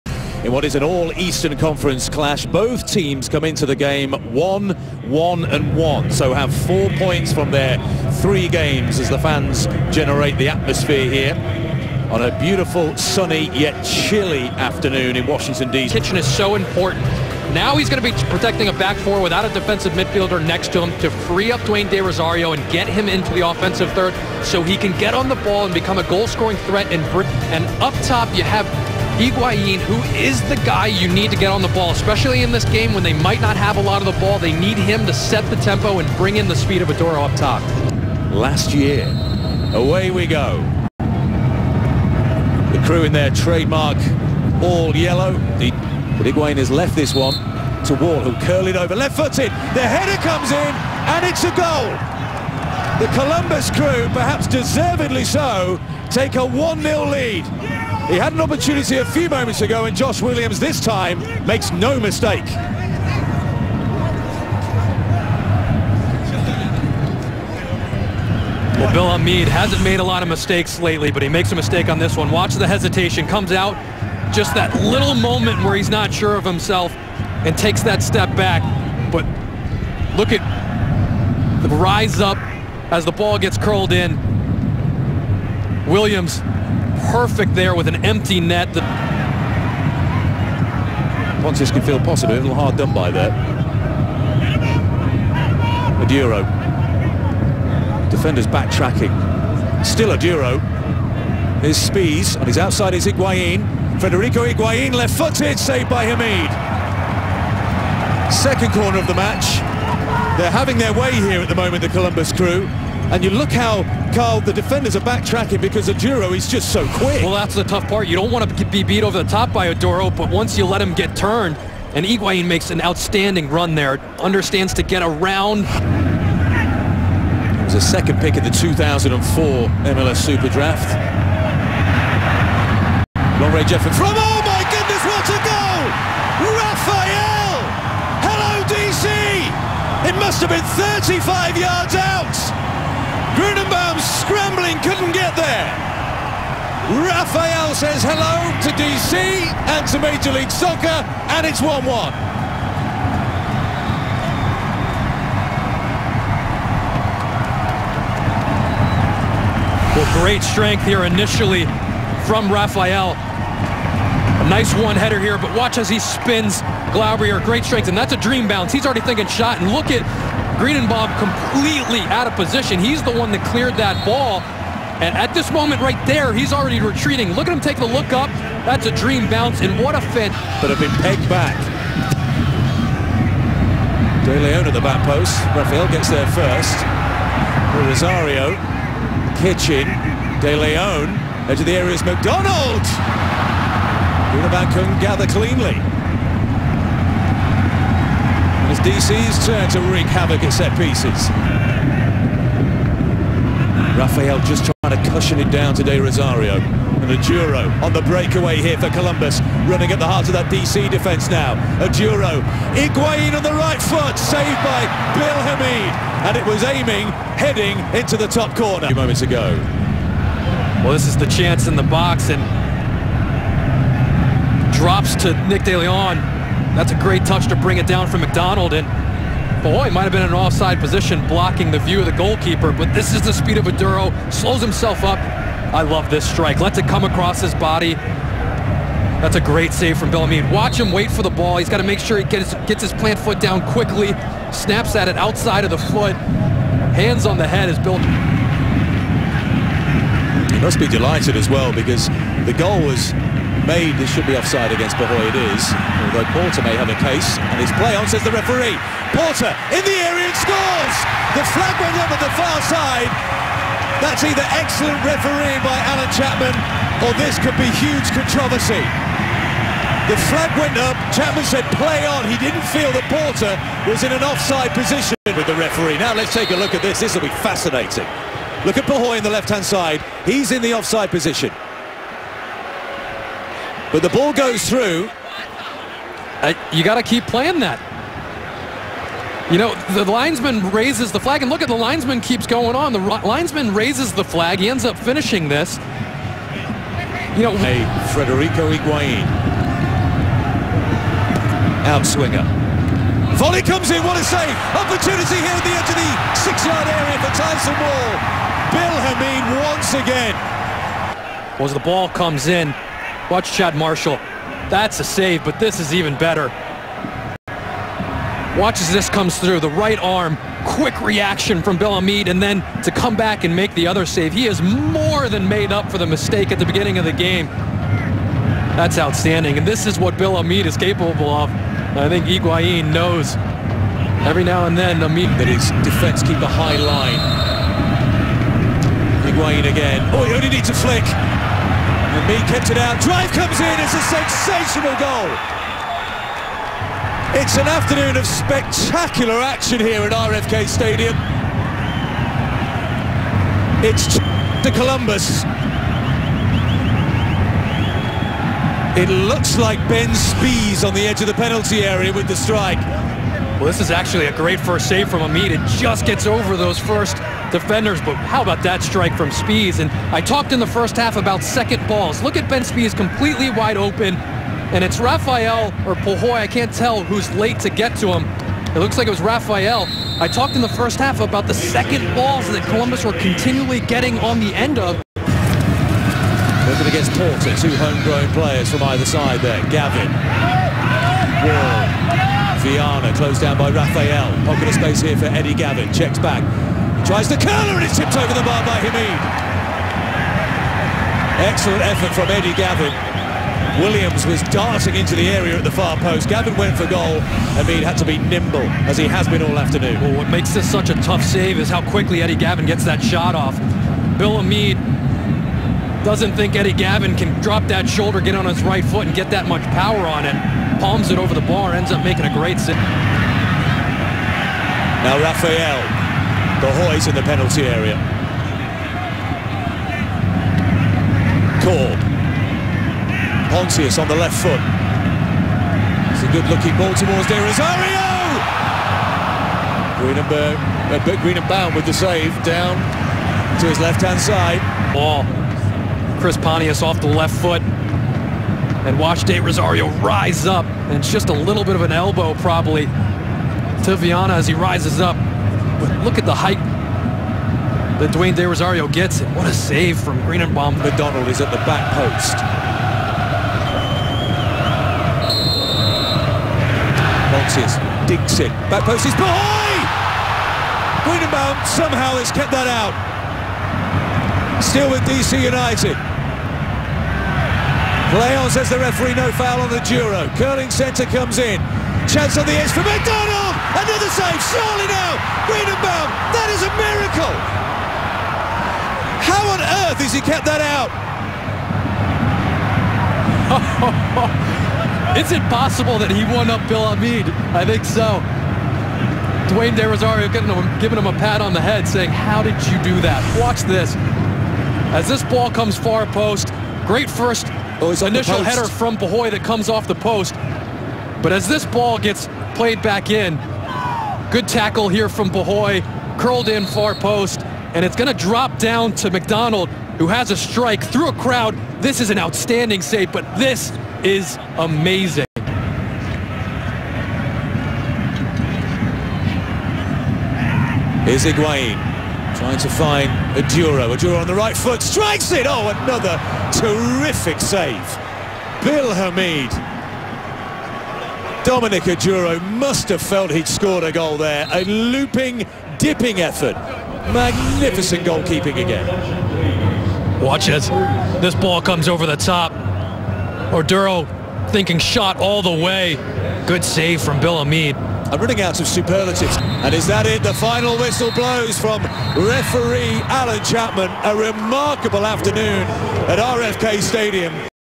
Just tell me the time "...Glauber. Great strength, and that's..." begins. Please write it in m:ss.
2:46.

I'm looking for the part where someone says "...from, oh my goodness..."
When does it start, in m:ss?
2:13.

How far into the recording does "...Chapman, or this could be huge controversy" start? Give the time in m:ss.
4:26.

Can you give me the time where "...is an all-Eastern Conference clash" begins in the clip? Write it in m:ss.
0:00.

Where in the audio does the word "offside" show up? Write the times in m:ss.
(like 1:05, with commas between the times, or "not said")
3:50, 4:14, 4:34, 4:40.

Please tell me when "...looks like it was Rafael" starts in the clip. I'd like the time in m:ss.
6:18.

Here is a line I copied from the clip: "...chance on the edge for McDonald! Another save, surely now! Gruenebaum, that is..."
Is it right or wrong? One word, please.
right.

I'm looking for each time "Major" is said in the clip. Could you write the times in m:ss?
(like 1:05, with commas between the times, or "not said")
2:29.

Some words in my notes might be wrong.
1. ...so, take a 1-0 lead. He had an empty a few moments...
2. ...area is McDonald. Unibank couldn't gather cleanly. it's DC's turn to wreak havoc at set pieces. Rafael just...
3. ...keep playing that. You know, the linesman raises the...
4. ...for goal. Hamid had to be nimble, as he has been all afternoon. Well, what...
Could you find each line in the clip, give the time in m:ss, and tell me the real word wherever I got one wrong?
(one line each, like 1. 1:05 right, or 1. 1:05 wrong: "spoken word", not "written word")
1. 0:55 wrong: "opportunity", not "empty"
2. 3:11 right
3. 4:47 right
4. 6:46 right.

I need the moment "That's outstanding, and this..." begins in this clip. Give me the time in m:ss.
5:28.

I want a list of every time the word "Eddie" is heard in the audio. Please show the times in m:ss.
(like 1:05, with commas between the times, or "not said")
6:35, 6:42, 6:52, 6:56.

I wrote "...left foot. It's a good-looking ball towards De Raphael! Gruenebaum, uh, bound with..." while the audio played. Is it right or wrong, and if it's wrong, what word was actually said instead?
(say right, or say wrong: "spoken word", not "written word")
wrong: "Rosario", not "Raphael".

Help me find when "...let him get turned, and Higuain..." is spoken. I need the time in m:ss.
2:00.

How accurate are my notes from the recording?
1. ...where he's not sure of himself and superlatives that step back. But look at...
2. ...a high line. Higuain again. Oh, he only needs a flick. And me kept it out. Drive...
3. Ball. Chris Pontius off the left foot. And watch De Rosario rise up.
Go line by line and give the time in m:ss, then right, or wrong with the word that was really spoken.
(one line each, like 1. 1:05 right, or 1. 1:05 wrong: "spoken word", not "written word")
1. 1:15 wrong: "takes", not "superlatives"
2. 5:36 right
3. 7:24 right.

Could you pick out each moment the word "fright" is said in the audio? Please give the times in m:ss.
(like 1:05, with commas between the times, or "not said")
not said.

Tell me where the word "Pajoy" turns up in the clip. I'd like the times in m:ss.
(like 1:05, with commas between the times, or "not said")
4:14, 4:38, 6:15, 8:28, 8:35.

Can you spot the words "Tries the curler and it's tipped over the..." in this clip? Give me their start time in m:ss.
6:37.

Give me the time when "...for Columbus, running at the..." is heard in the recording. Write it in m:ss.
3:28.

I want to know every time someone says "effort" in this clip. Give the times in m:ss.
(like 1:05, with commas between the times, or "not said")
6:41, 9:06.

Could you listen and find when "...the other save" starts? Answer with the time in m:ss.
5:23.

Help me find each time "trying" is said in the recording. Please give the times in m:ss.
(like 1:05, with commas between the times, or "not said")
3:24, 8:52.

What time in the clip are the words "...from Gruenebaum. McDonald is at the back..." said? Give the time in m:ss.
7:39.